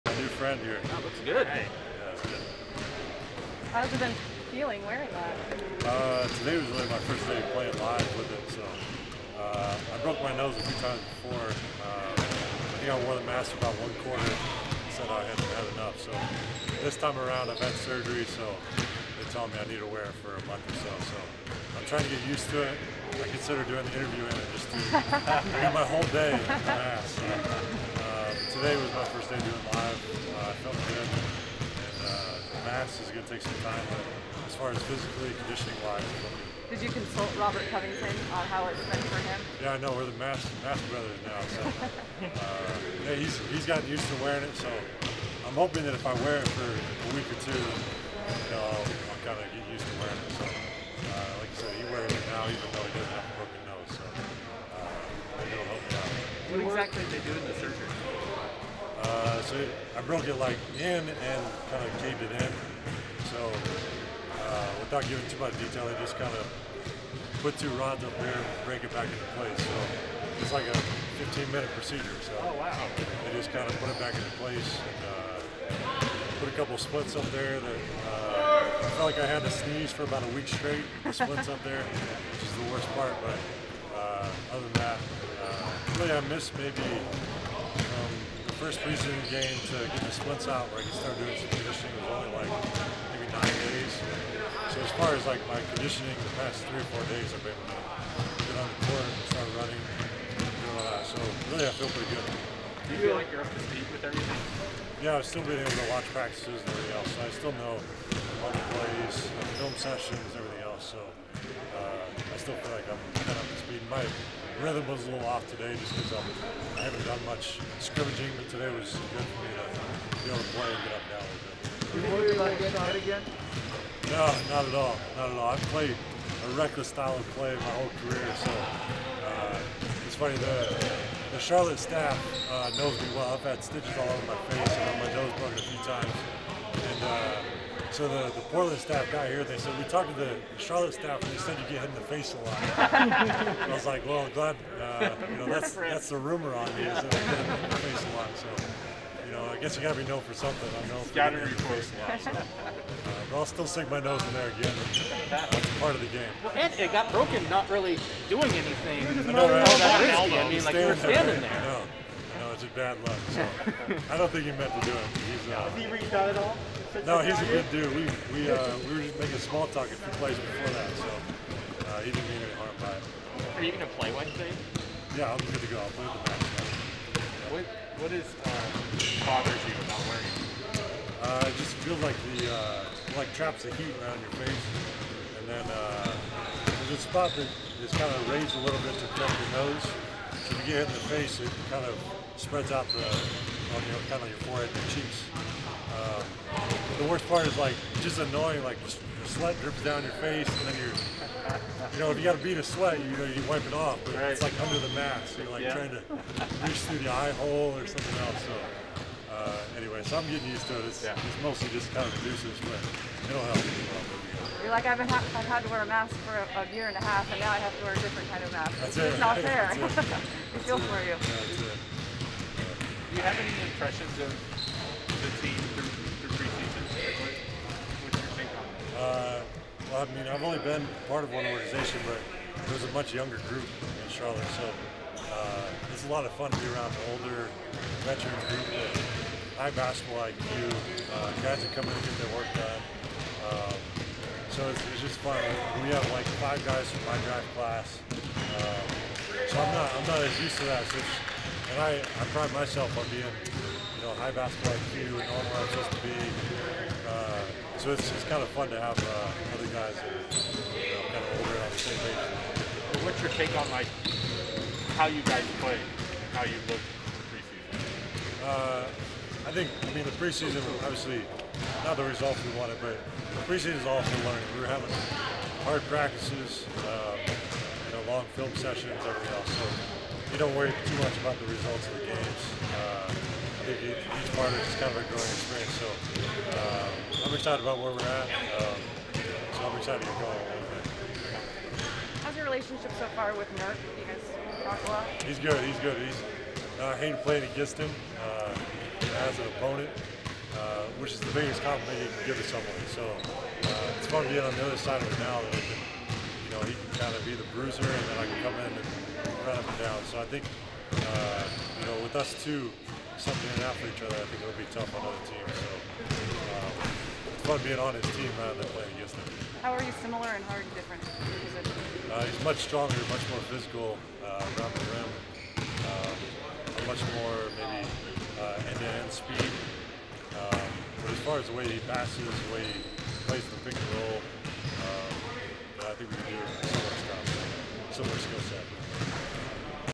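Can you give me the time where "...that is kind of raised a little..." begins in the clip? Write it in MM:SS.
03:07.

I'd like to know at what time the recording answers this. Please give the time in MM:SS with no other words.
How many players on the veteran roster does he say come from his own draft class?
04:06.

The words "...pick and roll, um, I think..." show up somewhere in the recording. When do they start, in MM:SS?
05:33.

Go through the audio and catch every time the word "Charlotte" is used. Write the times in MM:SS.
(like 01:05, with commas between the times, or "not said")
02:11, 02:20, 03:54.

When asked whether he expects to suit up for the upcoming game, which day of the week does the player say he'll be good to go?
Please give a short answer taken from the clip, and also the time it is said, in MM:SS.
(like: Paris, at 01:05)
Wednesday, at 02:54.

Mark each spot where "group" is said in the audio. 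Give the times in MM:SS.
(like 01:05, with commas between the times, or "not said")
03:53, 03:58.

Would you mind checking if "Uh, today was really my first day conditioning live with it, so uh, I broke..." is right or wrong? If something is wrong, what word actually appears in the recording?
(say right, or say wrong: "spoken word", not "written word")
wrong: "playing", not "conditioning".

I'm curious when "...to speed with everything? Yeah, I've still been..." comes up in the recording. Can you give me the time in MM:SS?
01:43.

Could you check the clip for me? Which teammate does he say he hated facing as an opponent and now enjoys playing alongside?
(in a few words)
Nurk.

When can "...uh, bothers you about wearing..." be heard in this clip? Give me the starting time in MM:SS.
02:58.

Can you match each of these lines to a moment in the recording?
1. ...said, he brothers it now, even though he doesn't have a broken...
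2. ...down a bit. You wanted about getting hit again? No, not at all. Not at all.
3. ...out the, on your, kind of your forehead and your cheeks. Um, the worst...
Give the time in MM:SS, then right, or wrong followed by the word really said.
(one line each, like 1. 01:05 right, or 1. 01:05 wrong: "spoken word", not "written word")
1. 00:51 wrong: "wears", not "brothers"
2. 02:01 wrong: "worried", not "wanted"
3. 03:12 right.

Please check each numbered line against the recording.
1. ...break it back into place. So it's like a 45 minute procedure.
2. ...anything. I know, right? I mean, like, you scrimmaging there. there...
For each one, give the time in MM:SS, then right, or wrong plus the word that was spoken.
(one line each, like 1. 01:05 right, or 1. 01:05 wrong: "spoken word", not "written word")
1. 01:08 wrong: "15", not "45"
2. 02:38 wrong: "standing", not "scrimmaging".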